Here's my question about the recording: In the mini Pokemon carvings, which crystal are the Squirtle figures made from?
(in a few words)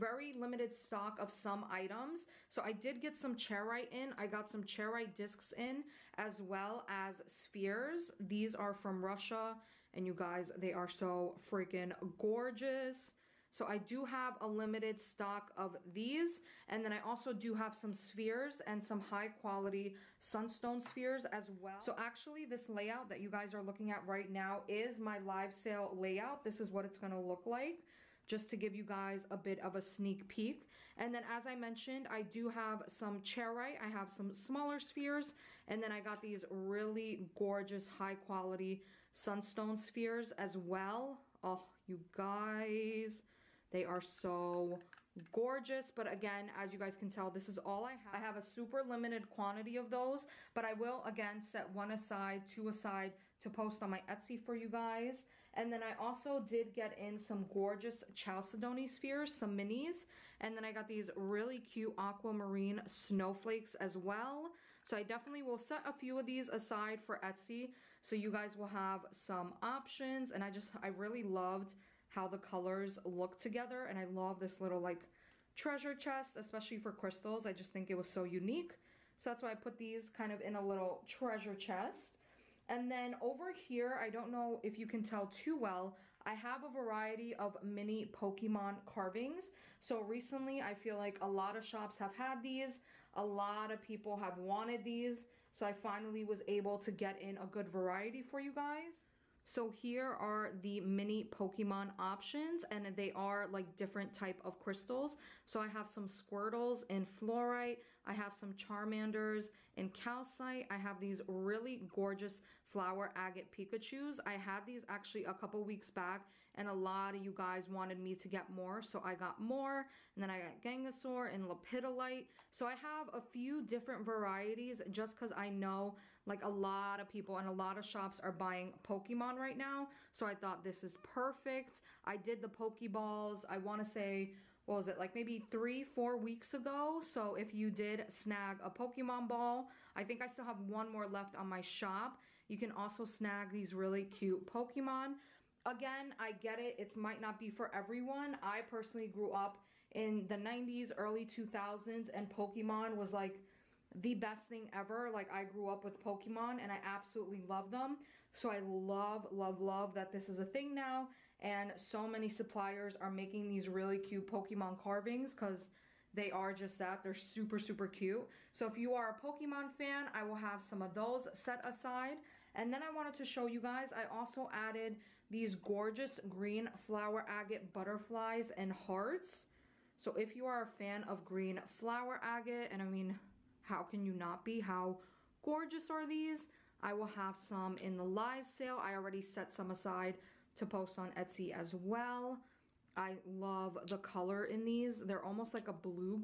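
Fluorite.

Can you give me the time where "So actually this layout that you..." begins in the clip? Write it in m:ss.
0:21.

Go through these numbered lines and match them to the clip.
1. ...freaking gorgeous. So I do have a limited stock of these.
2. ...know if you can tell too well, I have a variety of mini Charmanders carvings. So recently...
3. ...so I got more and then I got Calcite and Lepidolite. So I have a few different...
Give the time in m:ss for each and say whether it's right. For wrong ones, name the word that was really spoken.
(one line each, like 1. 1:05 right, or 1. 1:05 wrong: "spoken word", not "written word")
1. 0:11 right
2. 1:24 wrong: "Pokemon", not "Charmanders"
3. 1:58 wrong: "Gengasaur", not "Calcite".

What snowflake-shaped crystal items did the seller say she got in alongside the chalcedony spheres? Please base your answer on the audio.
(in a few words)
Aquamarine snowflakes.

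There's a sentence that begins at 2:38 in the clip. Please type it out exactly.
So I love, love, love that this is a thing now.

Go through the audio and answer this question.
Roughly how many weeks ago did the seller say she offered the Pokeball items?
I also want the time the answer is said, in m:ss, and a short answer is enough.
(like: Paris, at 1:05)
3 or 4 weeks, at 2:15.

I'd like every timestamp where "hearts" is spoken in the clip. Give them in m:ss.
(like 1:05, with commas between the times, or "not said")
2:58.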